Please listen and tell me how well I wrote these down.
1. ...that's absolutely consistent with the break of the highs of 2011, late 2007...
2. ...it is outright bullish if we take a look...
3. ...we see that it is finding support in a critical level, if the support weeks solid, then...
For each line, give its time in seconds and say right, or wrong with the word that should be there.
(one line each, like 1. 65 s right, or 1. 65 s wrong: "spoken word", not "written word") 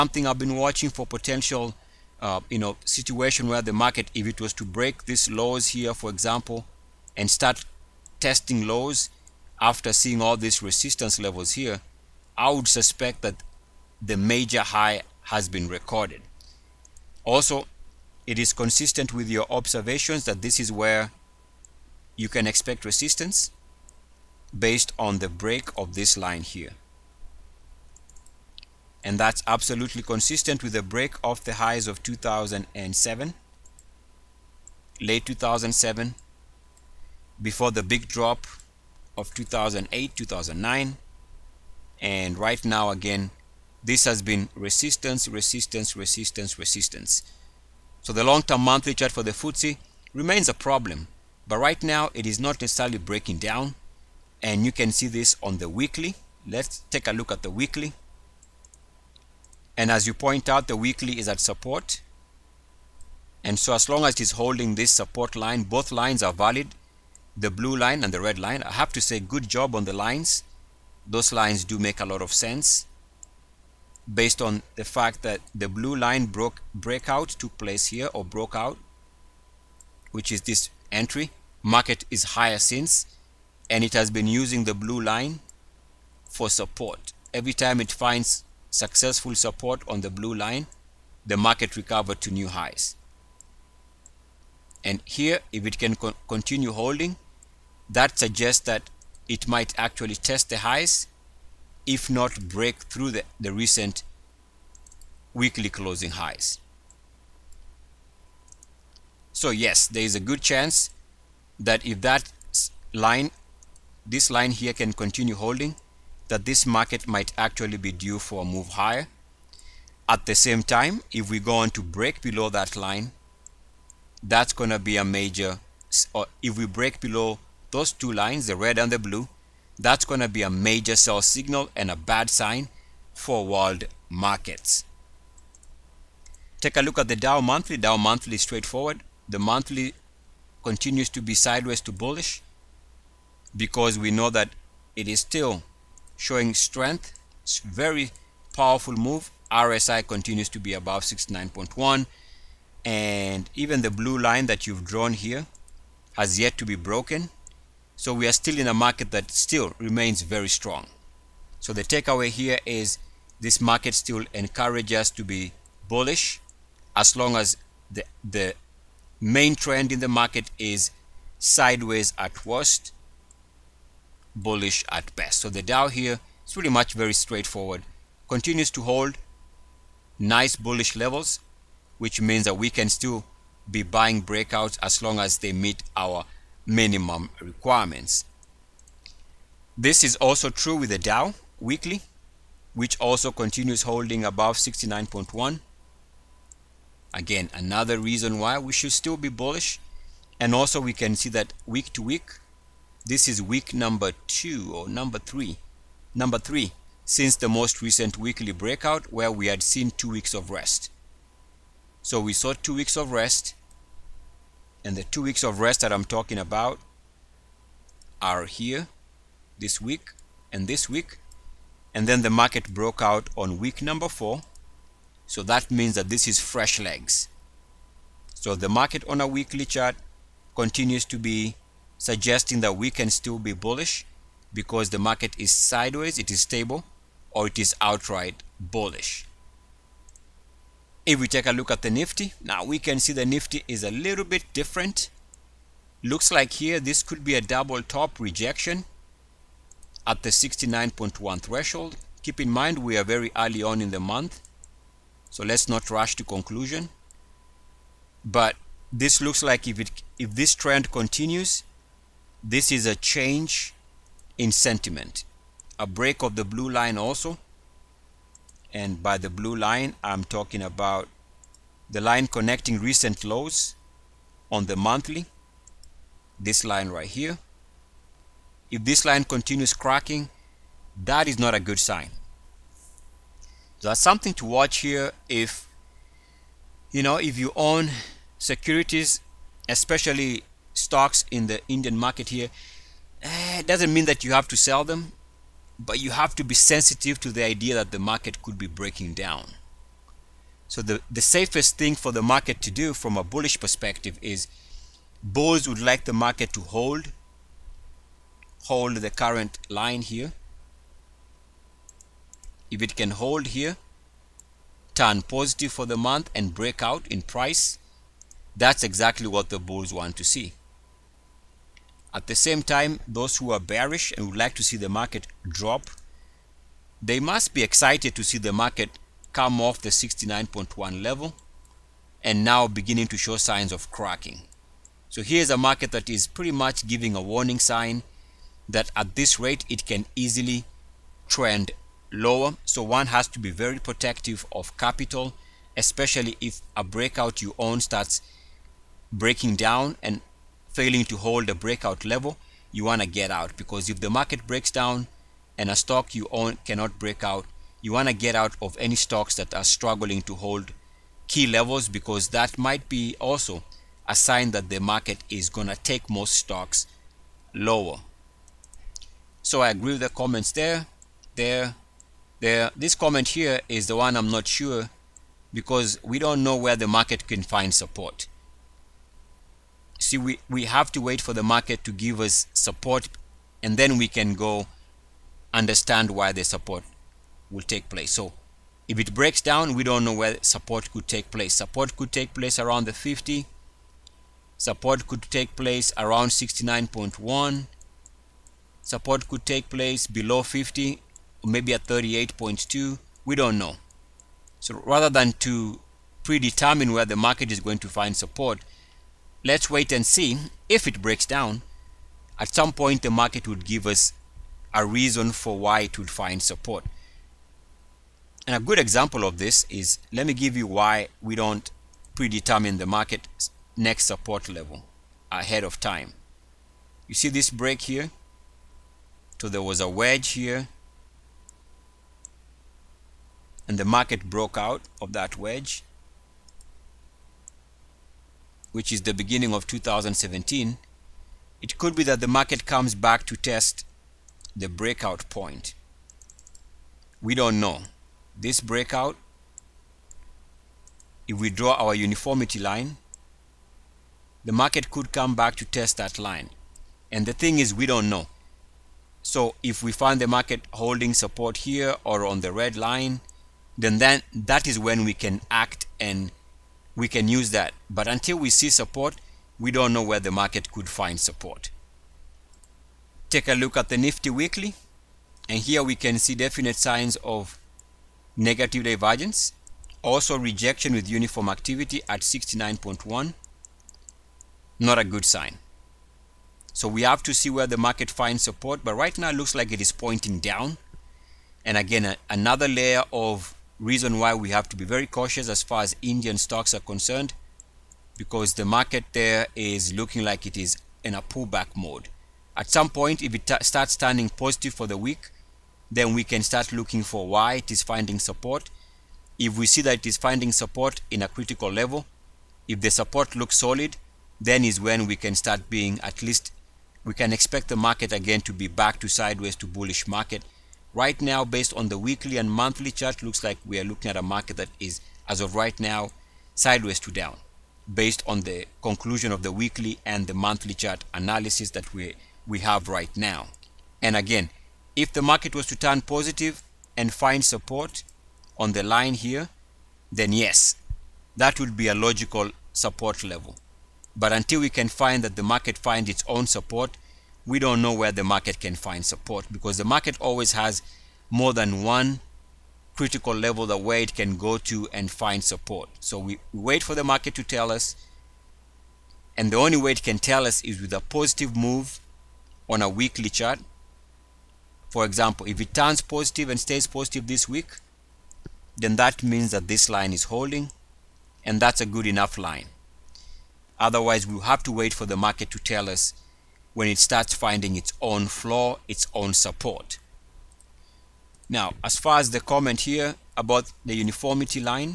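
1. 29 s wrong: "2007", not "2011"
2. 237 s right
3. 509 s wrong: "looks", not "weeks".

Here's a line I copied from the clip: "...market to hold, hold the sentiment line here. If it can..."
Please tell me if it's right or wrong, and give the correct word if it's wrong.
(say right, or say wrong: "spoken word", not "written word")
wrong: "current", not "sentiment".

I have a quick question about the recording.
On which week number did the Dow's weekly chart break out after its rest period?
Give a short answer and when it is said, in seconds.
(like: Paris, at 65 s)
4, at 223 s.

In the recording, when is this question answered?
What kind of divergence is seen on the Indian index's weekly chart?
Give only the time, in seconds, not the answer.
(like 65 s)
478 s.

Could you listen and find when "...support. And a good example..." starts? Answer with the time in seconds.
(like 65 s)
416 s.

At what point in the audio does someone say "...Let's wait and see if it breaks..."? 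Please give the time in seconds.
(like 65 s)
409 s.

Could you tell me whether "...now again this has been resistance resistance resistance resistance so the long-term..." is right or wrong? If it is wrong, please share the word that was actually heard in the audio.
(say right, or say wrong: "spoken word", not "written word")
right.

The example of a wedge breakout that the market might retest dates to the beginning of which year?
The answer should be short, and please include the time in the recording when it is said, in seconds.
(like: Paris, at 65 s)
2017, at 439 s.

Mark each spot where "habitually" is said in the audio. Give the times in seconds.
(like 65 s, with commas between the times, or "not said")
not said.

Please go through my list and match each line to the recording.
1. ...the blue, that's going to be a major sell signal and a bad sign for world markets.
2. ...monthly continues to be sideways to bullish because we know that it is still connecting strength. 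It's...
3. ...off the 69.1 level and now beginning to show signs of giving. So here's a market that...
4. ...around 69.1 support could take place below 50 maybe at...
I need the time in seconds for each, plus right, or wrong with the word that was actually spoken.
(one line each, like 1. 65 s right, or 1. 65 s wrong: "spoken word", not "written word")
1. 128 s right
2. 139 s wrong: "showing", not "connecting"
3. 329 s wrong: "cracking", not "giving"
4. 395 s right.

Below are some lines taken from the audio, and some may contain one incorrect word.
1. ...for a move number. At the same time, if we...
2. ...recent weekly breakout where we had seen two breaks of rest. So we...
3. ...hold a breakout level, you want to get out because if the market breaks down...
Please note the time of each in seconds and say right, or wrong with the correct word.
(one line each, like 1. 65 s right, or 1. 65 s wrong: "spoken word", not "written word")
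1. 118 s wrong: "higher", not "number"
2. 207 s wrong: "weeks", not "breaks"
3. 351 s right.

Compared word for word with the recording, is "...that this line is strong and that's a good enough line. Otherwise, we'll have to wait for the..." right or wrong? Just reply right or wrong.
wrong.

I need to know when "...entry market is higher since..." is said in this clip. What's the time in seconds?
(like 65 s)
80 s.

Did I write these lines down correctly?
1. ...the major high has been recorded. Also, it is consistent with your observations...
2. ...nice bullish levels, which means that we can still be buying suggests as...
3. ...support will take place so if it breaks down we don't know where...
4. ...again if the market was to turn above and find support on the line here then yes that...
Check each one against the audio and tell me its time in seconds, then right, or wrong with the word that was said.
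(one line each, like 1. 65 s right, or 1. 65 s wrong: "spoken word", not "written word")
1. 14 s right
2. 180 s wrong: "breakouts", not "suggests"
3. 386 s right
4. 534 s wrong: "positive", not "above".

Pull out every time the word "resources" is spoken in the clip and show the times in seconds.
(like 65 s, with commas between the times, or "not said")
not said.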